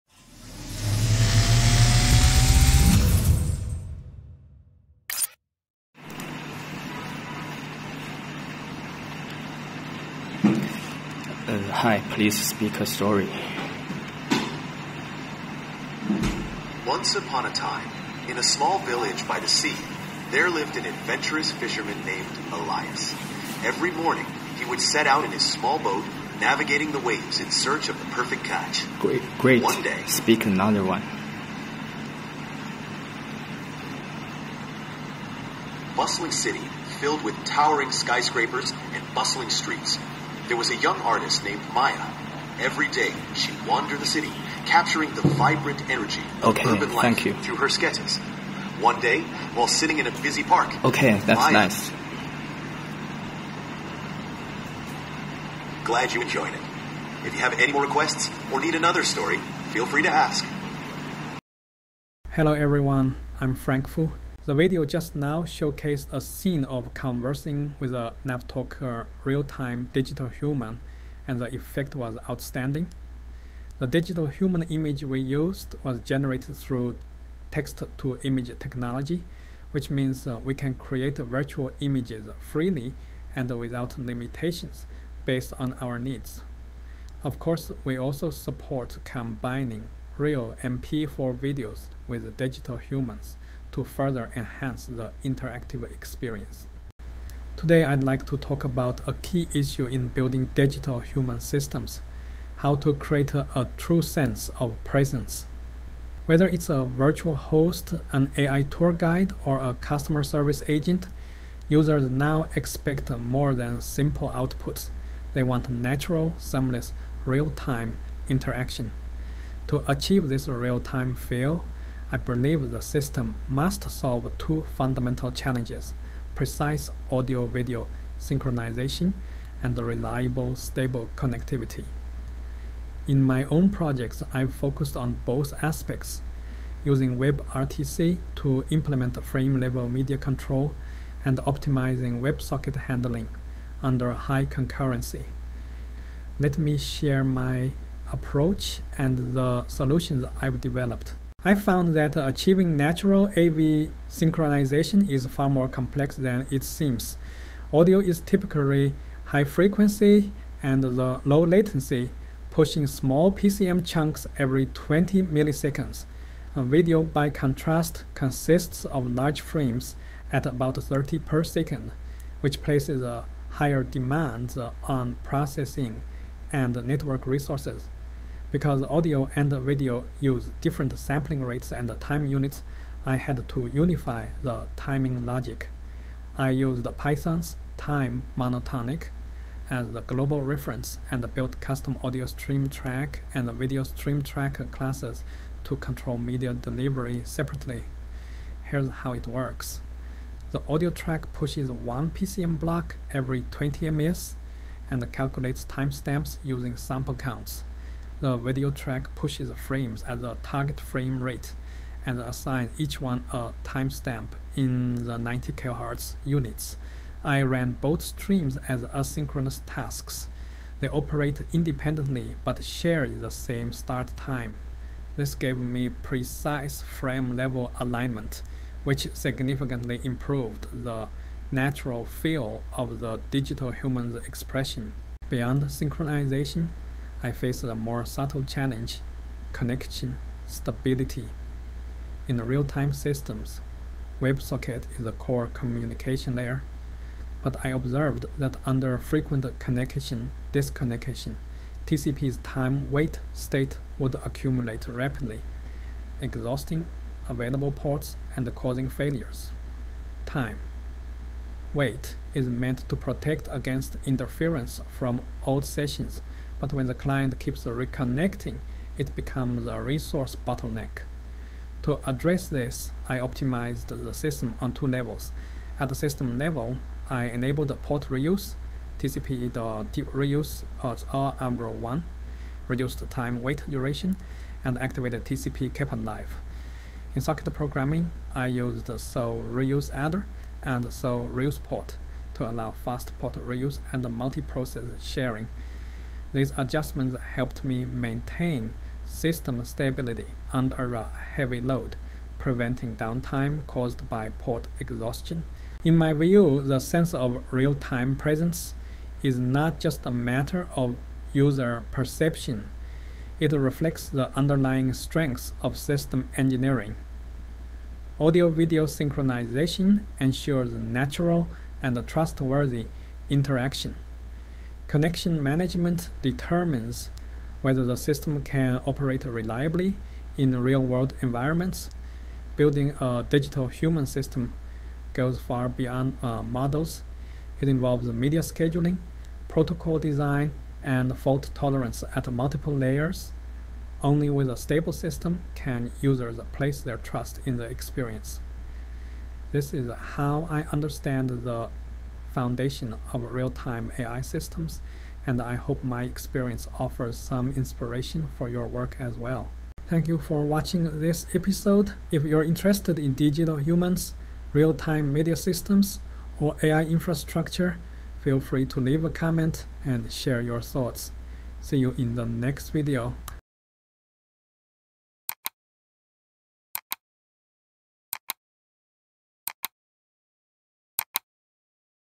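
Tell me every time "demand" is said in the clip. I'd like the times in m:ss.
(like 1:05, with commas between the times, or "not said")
2:53.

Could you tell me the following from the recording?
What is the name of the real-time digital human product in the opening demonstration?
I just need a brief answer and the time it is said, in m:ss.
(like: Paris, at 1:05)
NavTalker, at 1:08.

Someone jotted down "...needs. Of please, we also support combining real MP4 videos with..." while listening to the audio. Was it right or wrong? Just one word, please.
wrong.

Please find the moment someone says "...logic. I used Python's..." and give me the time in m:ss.
3:05.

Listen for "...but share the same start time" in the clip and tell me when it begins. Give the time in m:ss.
3:42.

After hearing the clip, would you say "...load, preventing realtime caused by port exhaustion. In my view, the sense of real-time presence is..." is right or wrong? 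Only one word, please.
wrong.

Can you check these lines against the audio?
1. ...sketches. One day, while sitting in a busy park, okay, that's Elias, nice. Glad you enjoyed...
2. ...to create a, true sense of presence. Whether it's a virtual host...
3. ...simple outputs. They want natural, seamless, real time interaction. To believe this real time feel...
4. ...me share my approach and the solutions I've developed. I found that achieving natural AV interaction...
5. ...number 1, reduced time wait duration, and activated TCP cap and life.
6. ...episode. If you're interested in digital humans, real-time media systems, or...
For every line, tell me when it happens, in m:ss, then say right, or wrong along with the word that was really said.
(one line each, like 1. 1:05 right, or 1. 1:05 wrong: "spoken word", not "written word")
1. 0:47 wrong: "Maya", not "Elias"
2. 1:42 right
3. 1:53 wrong: "achieve", not "believe"
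4. 2:26 wrong: "synchronization", not "interaction"
5. 4:41 right
6. 6:01 right.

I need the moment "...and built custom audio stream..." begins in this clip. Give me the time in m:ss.
3:11.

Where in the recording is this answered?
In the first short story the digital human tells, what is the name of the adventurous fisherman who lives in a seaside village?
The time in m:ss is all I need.
0:22.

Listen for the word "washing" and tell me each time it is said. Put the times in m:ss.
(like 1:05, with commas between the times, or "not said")
not said.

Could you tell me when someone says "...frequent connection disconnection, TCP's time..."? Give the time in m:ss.
4:08.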